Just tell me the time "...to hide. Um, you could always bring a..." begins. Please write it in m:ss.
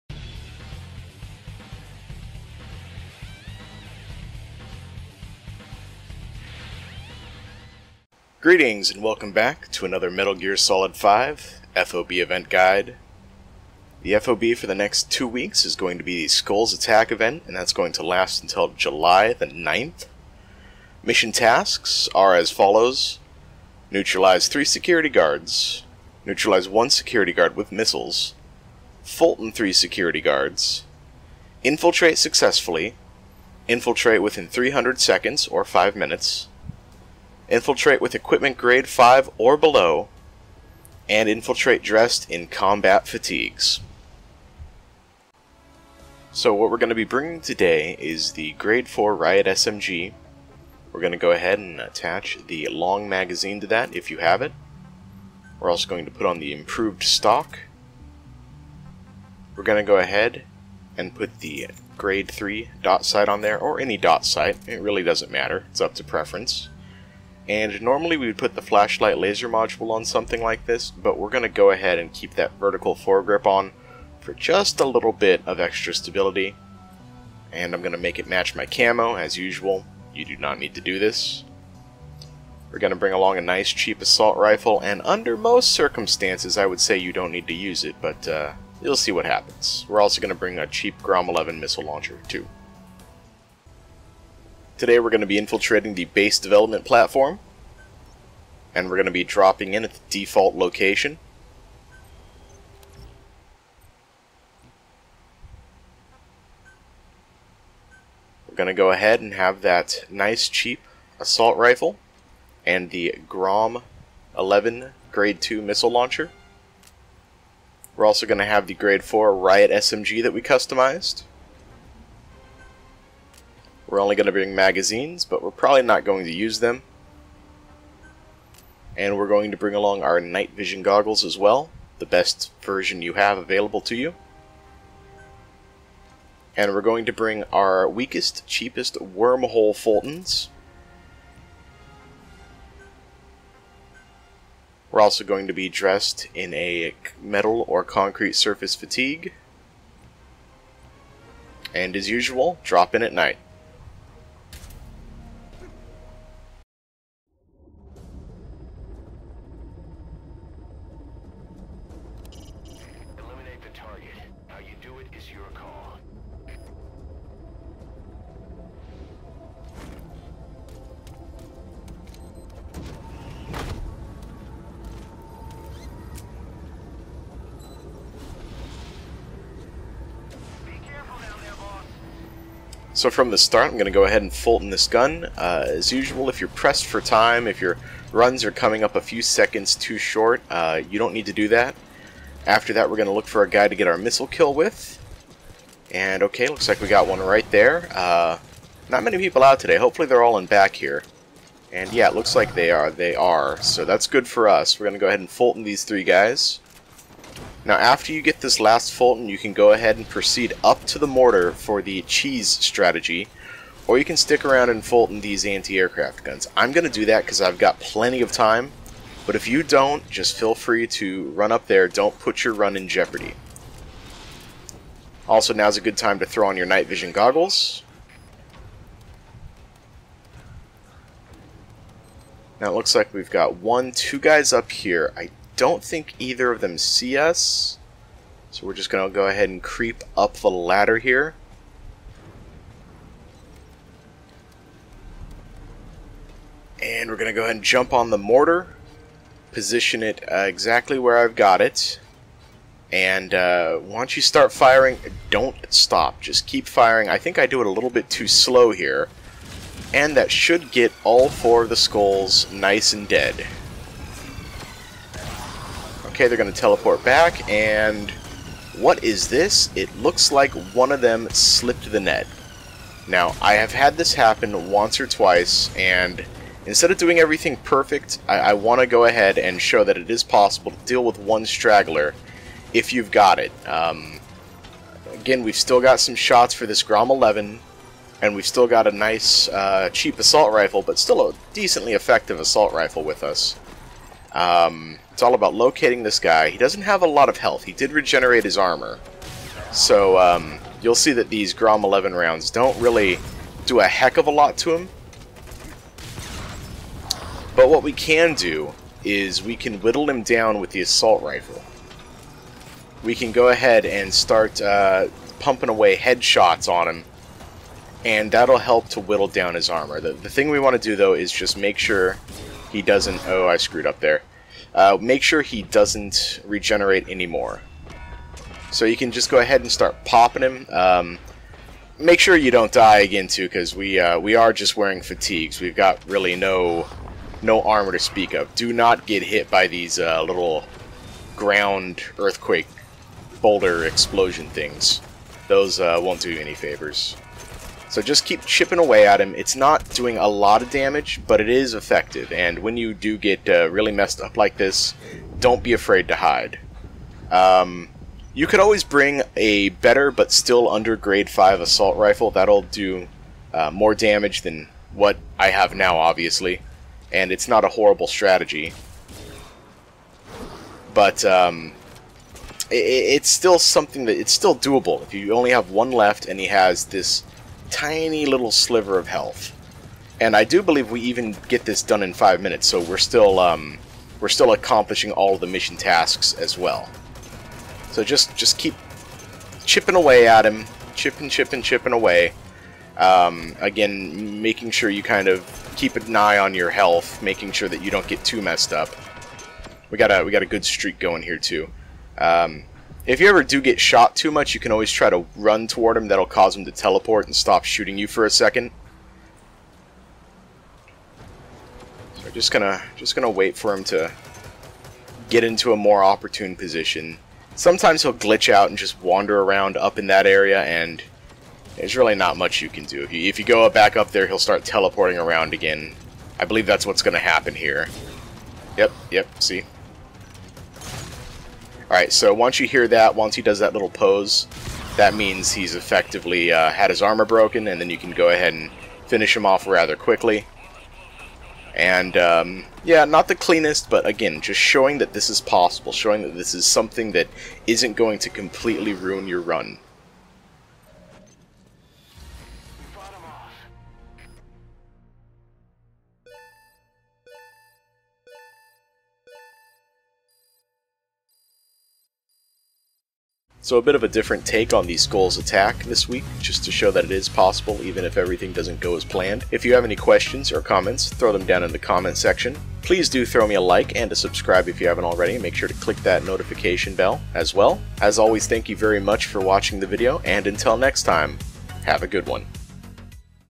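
5:56.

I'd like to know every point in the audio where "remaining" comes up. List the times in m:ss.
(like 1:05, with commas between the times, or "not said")
not said.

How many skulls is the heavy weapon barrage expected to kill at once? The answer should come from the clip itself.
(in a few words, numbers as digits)
4.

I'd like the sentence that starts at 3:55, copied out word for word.
I don't think either of them see us.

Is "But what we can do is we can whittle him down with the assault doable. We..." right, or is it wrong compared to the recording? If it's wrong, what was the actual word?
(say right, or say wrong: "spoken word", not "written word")
wrong: "rifle", not "doable".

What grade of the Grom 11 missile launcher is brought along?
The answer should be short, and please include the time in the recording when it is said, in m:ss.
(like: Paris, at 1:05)
Grade 2, at 1:55.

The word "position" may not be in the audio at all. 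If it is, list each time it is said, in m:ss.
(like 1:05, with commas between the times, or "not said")
4:09, 6:56.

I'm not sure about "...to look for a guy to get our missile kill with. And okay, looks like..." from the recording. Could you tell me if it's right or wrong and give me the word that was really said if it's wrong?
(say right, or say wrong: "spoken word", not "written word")
right.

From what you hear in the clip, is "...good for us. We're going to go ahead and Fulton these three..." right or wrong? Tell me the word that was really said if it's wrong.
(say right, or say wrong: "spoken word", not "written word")
right.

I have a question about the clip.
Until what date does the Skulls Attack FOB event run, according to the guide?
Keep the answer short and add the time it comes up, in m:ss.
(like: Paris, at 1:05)
July 9th, at 0:18.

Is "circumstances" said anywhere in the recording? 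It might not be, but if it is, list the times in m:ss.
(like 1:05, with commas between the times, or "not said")
1:25.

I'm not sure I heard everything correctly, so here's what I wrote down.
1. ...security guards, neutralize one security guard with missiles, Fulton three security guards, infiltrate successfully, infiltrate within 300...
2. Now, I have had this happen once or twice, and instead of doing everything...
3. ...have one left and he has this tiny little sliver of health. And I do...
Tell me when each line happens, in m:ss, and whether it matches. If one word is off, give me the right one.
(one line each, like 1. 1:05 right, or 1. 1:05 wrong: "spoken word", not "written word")
1. 0:24 right
2. 4:33 right
3. 6:15 right.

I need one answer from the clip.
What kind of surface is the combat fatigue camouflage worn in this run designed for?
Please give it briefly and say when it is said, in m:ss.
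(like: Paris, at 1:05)
metal or concrete, at 2:27.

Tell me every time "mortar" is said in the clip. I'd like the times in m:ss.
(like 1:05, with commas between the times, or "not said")
3:31, 4:08.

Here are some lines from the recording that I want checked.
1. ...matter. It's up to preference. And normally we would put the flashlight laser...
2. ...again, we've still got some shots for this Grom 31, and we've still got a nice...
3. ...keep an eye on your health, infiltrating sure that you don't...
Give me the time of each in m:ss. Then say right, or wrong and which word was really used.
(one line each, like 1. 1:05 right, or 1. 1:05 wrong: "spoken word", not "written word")
1. 1:05 right
2. 4:45 wrong: "11", not "31"
3. 6:35 wrong: "making", not "infiltrating".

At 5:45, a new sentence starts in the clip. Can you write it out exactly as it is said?
Those uh, won't do you any favors.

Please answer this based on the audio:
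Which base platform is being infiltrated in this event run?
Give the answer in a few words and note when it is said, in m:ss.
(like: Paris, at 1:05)
base development platform, at 1:36.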